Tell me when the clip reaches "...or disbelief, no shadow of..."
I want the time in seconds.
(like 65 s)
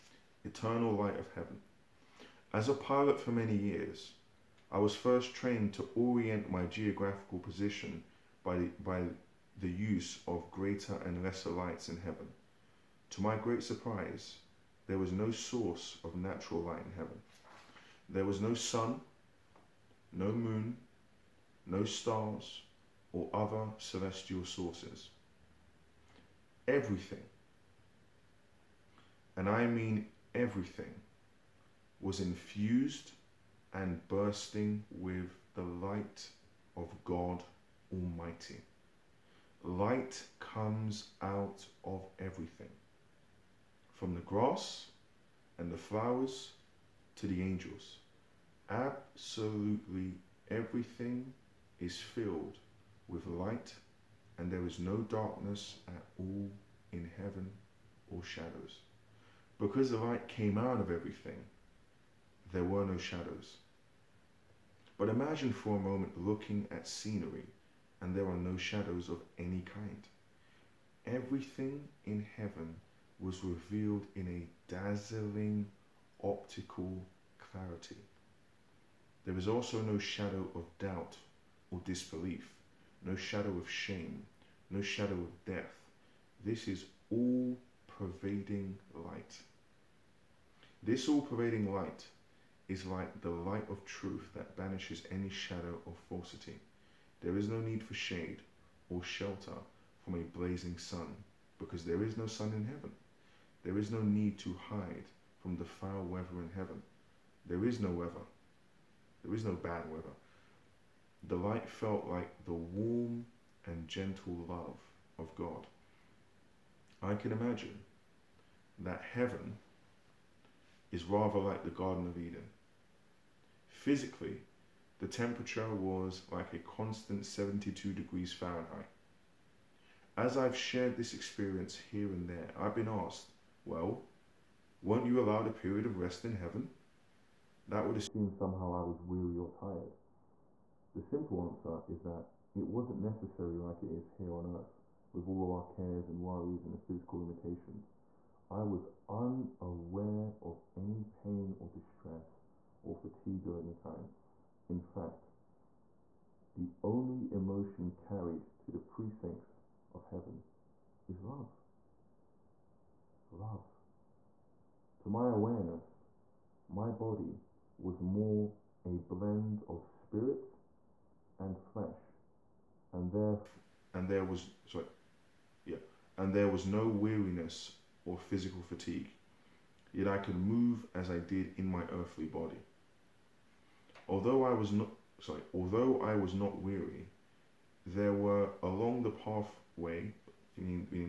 81 s.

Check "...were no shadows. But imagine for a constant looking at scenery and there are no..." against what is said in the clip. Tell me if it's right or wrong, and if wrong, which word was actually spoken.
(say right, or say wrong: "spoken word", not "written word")
wrong: "moment", not "constant".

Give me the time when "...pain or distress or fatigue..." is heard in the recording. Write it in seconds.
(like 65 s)
151 s.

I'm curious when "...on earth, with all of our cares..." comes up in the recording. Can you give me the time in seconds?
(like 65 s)
144 s.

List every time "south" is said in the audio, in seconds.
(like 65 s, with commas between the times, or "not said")
not said.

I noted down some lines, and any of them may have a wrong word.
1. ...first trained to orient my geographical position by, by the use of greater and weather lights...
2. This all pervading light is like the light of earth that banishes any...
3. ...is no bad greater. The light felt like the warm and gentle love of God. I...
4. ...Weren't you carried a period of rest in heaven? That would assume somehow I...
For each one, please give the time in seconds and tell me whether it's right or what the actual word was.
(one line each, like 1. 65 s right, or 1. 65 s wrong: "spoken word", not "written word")
1. 4 s wrong: "lesser", not "weather"
2. 90 s wrong: "truth", not "earth"
3. 109 s wrong: "weather", not "greater"
4. 134 s wrong: "allowed", not "carried".